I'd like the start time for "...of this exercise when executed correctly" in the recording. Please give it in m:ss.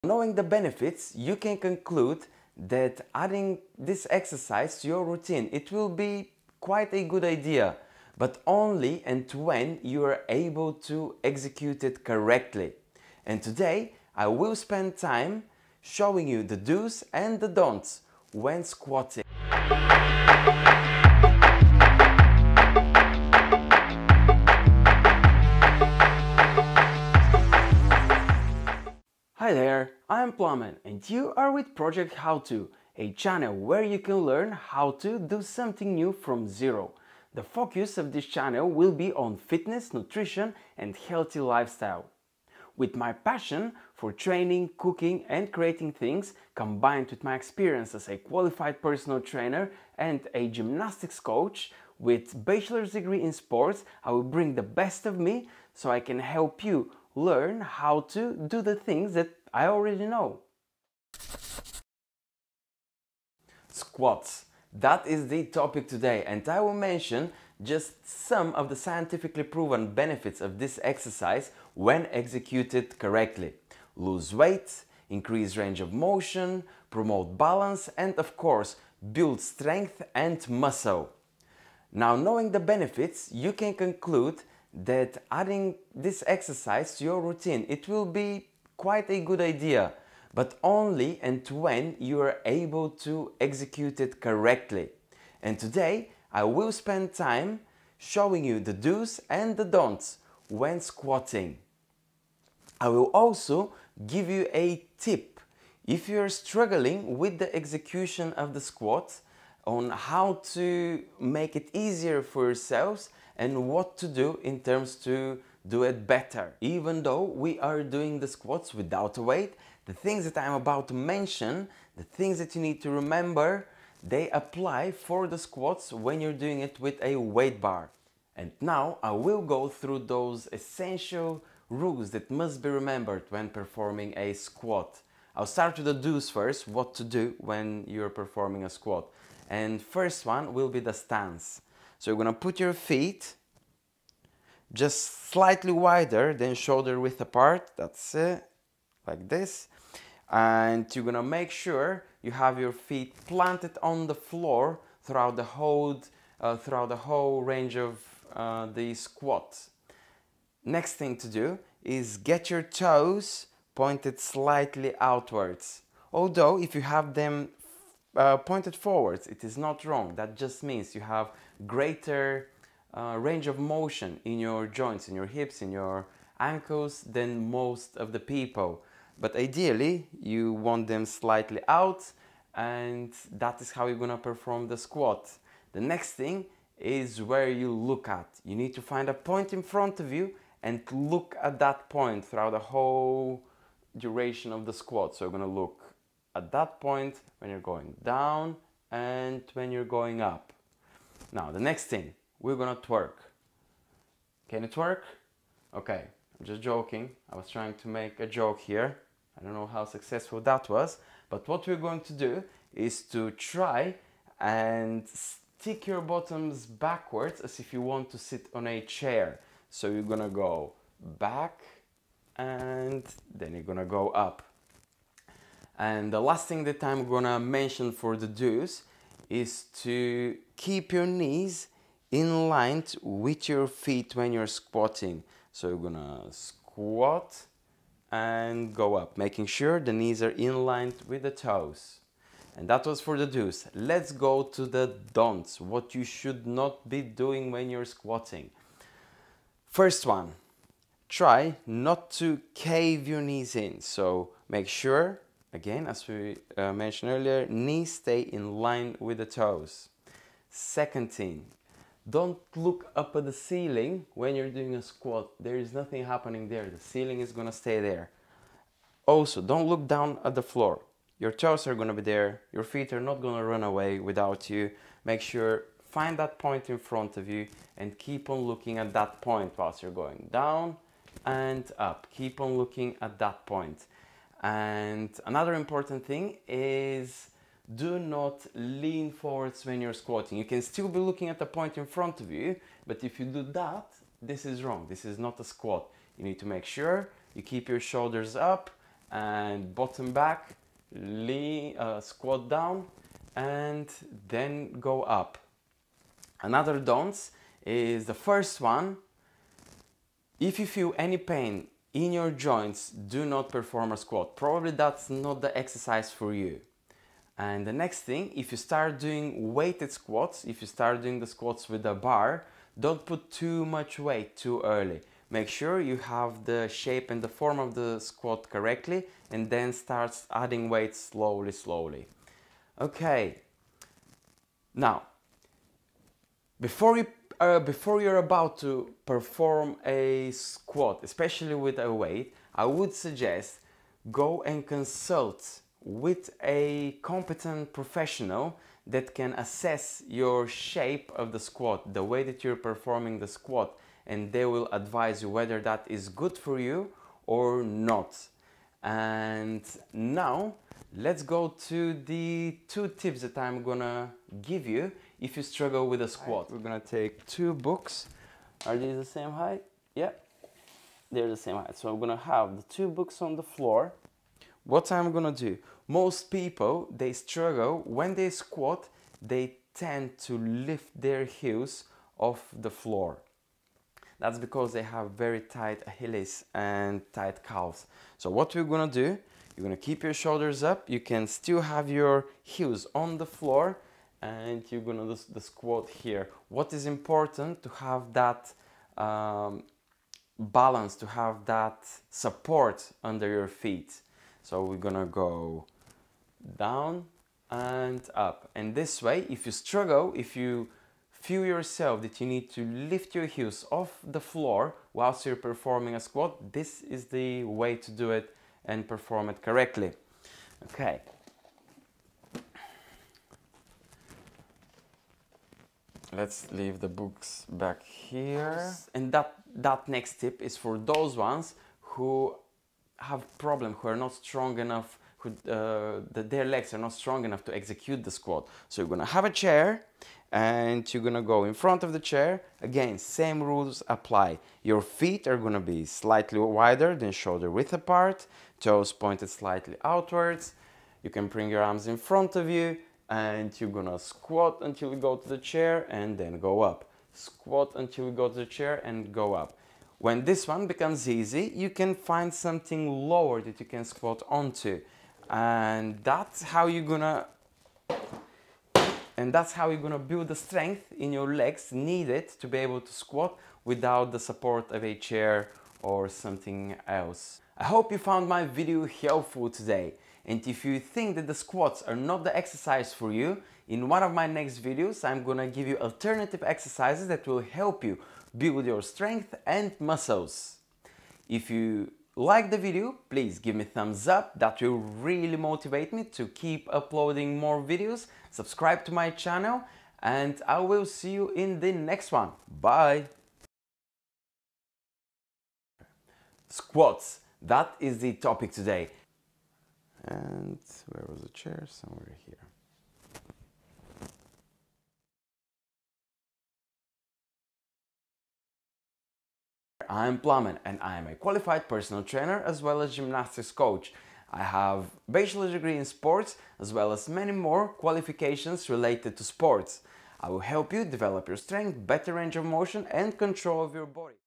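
1:10.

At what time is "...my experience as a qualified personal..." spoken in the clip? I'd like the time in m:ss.
0:47.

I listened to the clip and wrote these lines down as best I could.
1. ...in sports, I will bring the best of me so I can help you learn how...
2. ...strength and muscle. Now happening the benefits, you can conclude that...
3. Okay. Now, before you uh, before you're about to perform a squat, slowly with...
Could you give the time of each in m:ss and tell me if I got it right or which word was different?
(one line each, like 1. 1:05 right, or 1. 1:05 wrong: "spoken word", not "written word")
1. 0:53 right
2. 1:19 wrong: "knowing", not "happening"
3. 5:32 wrong: "especially", not "slowly".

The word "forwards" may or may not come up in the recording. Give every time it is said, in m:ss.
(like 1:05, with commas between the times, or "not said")
2:48, 4:49.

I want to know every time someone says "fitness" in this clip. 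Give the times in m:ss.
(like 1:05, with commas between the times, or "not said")
0:39.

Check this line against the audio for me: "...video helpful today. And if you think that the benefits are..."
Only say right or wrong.
wrong.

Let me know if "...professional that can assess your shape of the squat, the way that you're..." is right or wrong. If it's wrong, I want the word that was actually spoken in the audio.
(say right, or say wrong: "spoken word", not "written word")
right.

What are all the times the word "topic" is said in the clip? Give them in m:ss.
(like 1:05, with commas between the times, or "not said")
1:05, 8:28.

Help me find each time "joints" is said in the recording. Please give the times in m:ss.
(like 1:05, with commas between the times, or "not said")
2:54, 5:12.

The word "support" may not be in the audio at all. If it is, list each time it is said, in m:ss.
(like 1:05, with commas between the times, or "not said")
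6:42, 7:54.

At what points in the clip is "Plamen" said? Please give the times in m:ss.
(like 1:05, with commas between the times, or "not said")
0:30, 8:40.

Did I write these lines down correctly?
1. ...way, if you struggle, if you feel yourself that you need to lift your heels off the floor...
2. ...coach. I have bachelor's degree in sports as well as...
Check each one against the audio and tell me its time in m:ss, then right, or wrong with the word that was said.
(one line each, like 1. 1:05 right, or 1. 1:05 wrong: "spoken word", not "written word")
1. 6:49 right
2. 8:43 right.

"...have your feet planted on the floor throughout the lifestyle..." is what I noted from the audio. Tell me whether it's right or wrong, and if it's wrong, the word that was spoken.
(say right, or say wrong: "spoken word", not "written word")
wrong: "whole", not "lifestyle".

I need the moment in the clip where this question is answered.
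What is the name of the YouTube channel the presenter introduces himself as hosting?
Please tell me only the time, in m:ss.
0:31.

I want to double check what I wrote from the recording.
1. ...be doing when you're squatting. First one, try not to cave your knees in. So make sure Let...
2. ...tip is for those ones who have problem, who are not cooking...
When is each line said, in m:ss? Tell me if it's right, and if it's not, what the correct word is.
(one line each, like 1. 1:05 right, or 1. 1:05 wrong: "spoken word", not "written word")
1. 4:06 wrong: "Again", not "Let"
2. 7:10 wrong: "strong", not "cooking".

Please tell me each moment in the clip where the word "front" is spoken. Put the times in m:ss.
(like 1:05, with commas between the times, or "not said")
3:09, 4:36, 4:51, 7:21, 7:31.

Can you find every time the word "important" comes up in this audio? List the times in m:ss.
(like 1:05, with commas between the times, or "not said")
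4:45, 6:36.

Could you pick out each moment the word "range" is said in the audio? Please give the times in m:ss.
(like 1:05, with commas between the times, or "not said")
1:15, 2:37, 2:53, 8:52.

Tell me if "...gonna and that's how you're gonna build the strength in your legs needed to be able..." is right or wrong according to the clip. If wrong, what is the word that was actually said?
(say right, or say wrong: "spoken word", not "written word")
right.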